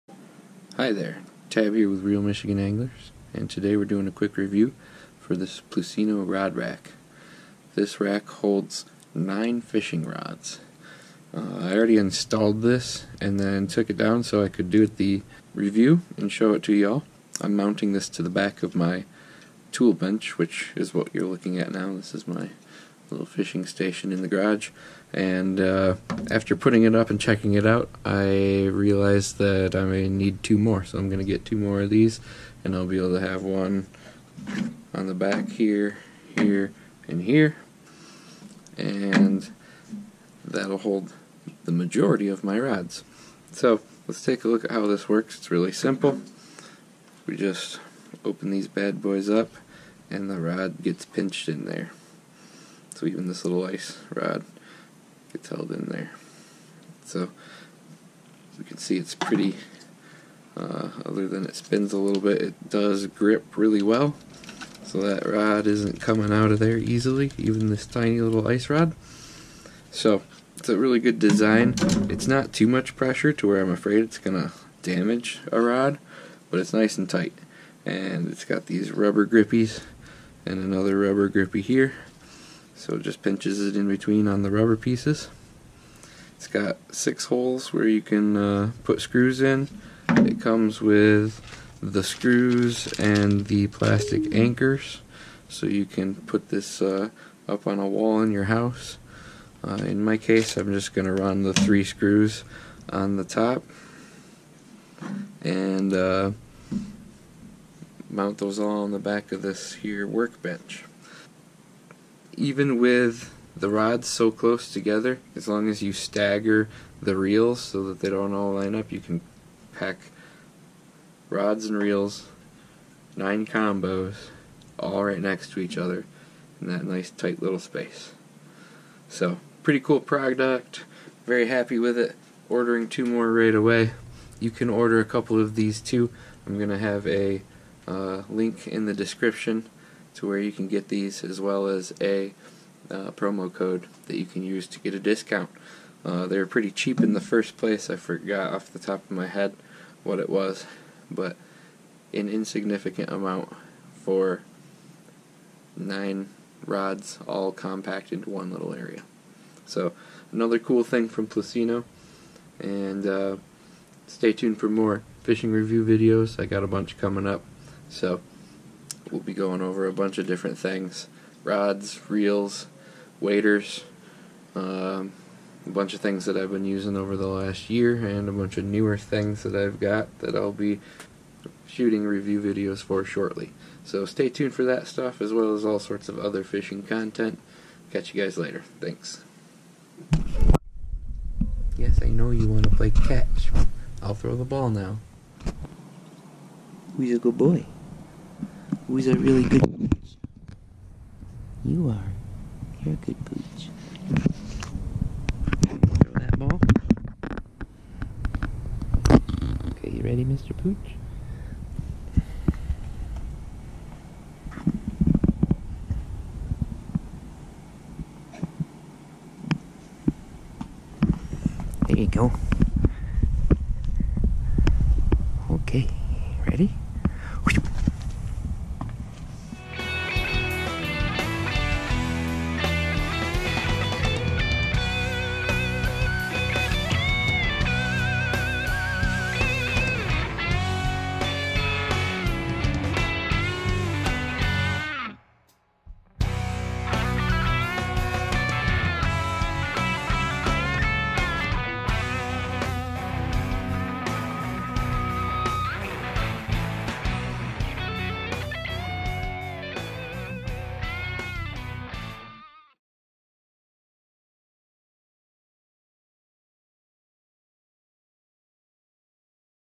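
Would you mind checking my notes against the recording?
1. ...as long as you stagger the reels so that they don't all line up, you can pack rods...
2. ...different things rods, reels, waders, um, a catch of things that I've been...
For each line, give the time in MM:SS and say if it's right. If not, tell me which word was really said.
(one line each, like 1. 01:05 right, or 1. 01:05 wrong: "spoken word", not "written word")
1. 01:55 right
2. 02:50 wrong: "bunch", not "catch".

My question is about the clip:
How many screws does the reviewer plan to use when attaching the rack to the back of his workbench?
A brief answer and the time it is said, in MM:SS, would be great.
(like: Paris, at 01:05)
3, at 01:41.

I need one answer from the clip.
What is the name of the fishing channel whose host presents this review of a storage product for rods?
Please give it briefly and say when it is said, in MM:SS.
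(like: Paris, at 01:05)
Reel Michigan Anglers, at 00:02.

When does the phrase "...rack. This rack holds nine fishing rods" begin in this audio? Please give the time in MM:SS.
00:06.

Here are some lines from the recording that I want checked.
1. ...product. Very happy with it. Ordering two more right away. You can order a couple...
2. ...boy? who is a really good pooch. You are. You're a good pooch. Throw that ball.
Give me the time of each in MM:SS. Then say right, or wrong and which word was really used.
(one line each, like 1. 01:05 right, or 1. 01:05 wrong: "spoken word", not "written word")
1. 02:09 right
2. 03:17 right.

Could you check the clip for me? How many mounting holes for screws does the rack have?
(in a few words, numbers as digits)
6.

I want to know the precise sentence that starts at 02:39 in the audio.
So, another cool thing from Plusinno, and uh, stay tuned for more fishing review videos.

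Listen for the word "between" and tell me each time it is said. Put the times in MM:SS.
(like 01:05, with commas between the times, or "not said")
01:23.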